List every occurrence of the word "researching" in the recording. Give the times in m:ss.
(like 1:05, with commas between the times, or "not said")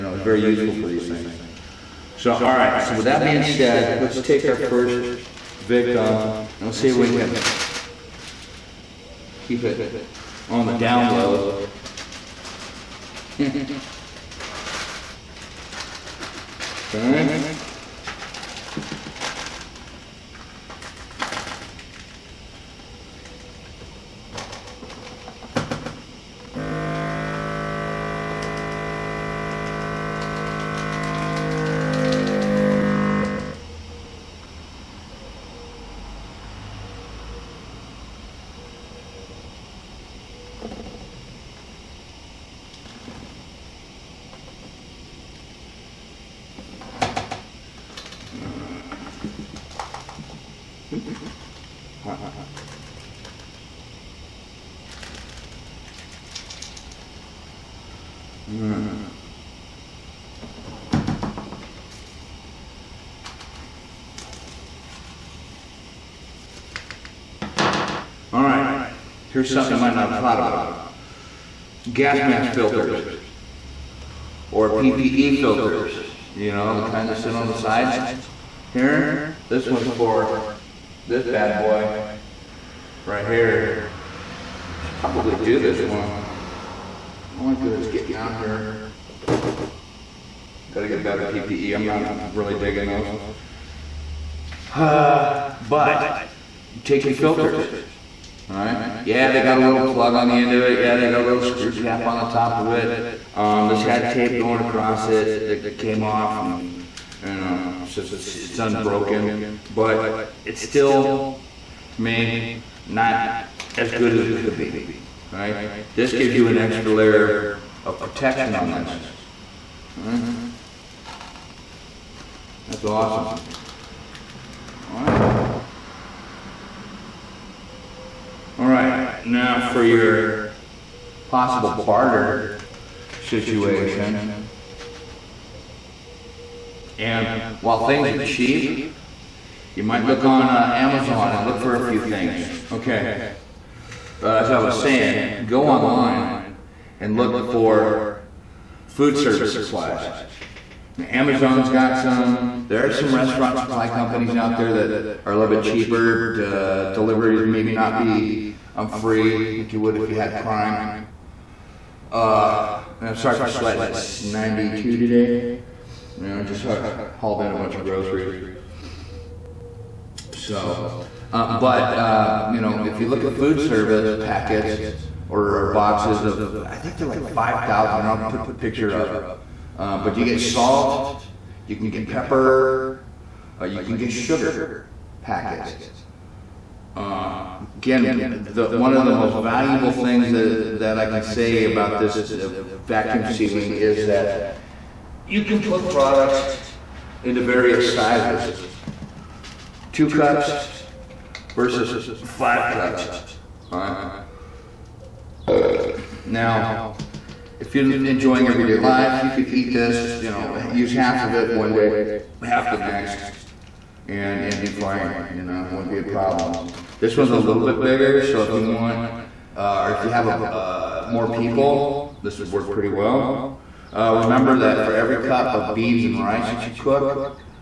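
not said.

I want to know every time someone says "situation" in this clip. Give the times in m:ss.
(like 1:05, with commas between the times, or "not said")
2:13.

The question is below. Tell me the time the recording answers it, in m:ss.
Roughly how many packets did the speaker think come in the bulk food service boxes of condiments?
2:57.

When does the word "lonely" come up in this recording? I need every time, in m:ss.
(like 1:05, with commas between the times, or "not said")
not said.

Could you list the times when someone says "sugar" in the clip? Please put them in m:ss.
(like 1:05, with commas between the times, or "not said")
3:04.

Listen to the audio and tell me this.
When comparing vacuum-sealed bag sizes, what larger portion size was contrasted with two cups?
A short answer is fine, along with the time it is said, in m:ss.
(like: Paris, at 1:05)
5 cups, at 3:22.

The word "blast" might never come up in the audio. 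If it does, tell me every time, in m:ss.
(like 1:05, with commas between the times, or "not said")
not said.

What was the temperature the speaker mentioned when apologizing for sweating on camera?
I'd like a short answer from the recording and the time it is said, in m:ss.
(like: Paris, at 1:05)
92, at 2:44.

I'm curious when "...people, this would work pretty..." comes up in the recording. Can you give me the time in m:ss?
3:41.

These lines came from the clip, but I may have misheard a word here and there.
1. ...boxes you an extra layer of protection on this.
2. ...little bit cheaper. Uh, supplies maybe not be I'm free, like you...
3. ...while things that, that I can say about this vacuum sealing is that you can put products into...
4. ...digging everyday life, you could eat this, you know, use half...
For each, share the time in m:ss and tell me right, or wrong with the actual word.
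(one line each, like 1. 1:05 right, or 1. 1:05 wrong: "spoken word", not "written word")
1. 1:56 wrong: "gives", not "boxes"
2. 2:35 wrong: "deliveries", not "supplies"
3. 3:09 wrong: "valuable", not "while"
4. 3:28 wrong: "enjoying", not "digging".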